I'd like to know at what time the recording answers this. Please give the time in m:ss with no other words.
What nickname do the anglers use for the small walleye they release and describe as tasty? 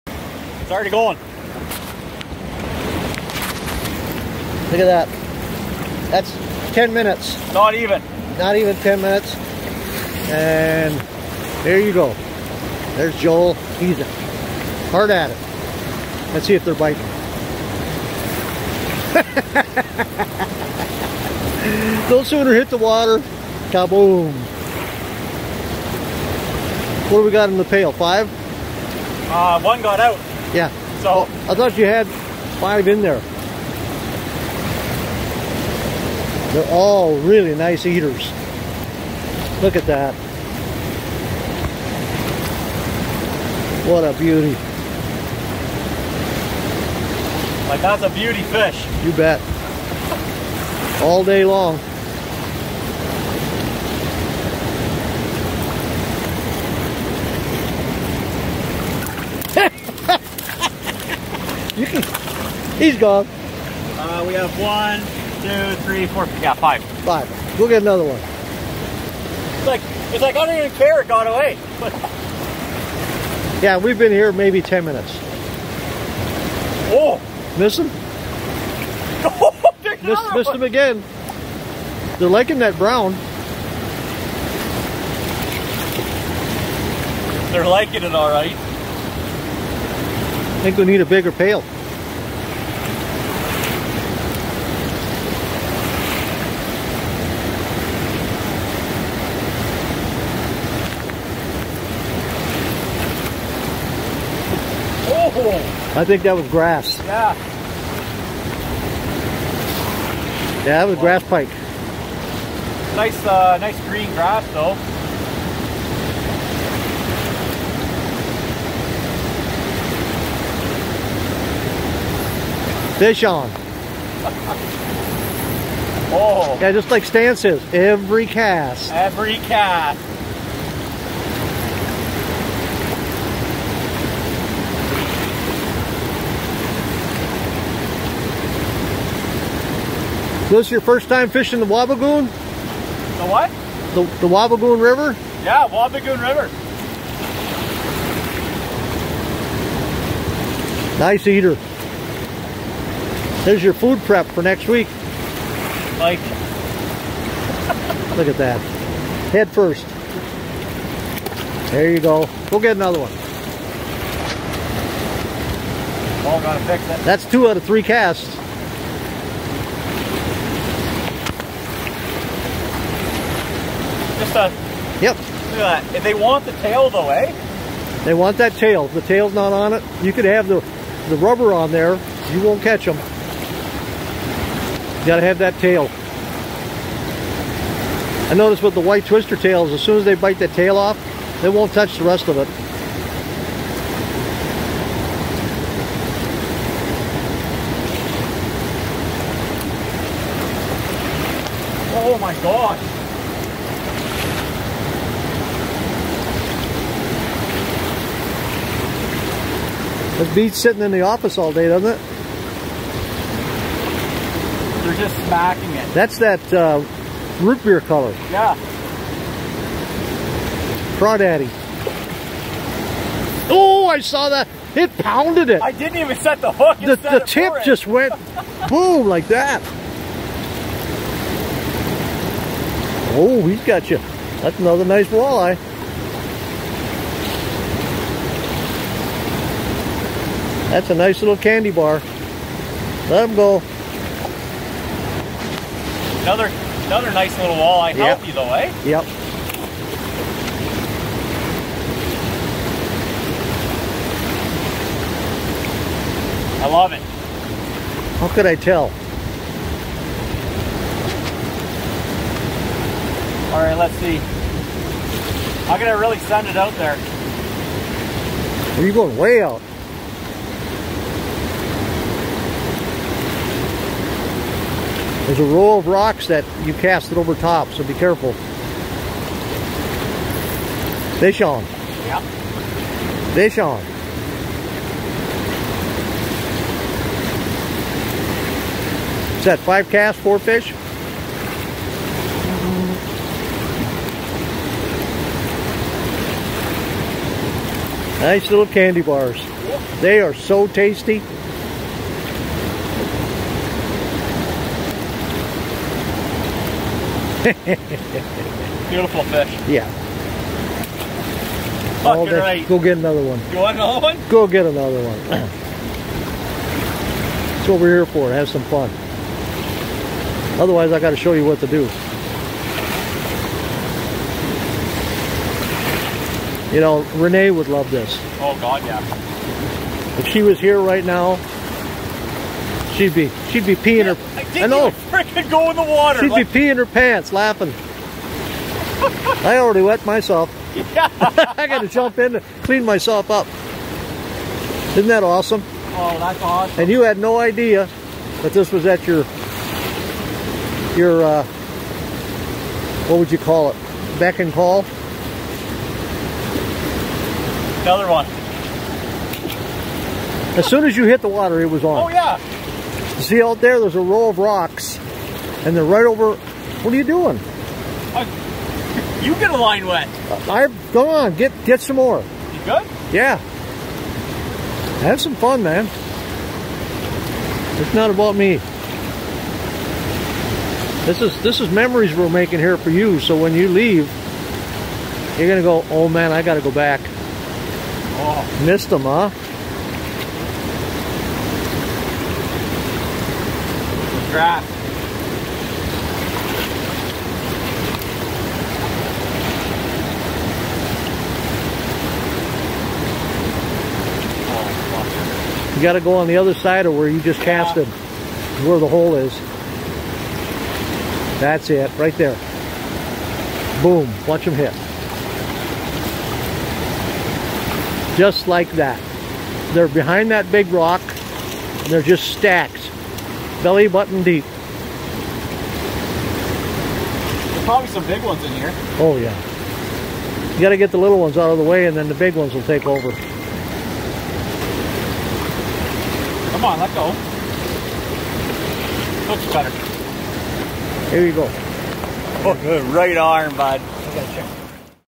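4:01.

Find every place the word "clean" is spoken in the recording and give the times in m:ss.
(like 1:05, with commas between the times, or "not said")
5:42.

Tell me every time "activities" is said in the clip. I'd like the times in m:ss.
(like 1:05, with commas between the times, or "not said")
not said.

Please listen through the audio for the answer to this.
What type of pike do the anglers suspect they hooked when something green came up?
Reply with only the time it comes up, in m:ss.
1:50.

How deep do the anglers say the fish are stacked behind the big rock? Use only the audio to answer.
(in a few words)
belly button deep.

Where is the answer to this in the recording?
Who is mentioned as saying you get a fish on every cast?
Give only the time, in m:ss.
2:07.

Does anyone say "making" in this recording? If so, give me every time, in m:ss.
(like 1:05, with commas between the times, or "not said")
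6:22.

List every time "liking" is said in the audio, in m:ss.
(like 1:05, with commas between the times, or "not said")
1:22, 1:27.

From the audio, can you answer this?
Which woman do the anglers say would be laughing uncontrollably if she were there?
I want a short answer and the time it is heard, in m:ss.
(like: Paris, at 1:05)
Renee, at 5:27.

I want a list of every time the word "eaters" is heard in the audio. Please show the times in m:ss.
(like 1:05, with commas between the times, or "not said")
0:37, 2:31.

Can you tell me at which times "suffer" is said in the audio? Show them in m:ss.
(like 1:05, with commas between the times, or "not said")
not said.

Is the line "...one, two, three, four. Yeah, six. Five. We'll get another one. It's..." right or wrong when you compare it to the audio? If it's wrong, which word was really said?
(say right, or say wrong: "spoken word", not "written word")
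wrong: "five", not "six".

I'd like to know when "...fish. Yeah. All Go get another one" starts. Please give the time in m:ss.
5:09.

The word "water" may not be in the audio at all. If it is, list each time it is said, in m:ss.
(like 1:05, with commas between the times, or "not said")
0:22, 5:35, 6:01.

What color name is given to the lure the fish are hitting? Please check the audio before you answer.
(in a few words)
root beer.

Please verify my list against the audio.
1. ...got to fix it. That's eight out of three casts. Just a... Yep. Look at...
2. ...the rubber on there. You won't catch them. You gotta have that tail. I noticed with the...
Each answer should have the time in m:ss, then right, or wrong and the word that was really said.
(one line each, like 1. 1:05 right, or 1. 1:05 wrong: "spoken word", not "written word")
1. 2:46 wrong: "two", not "eight"
2. 3:01 right.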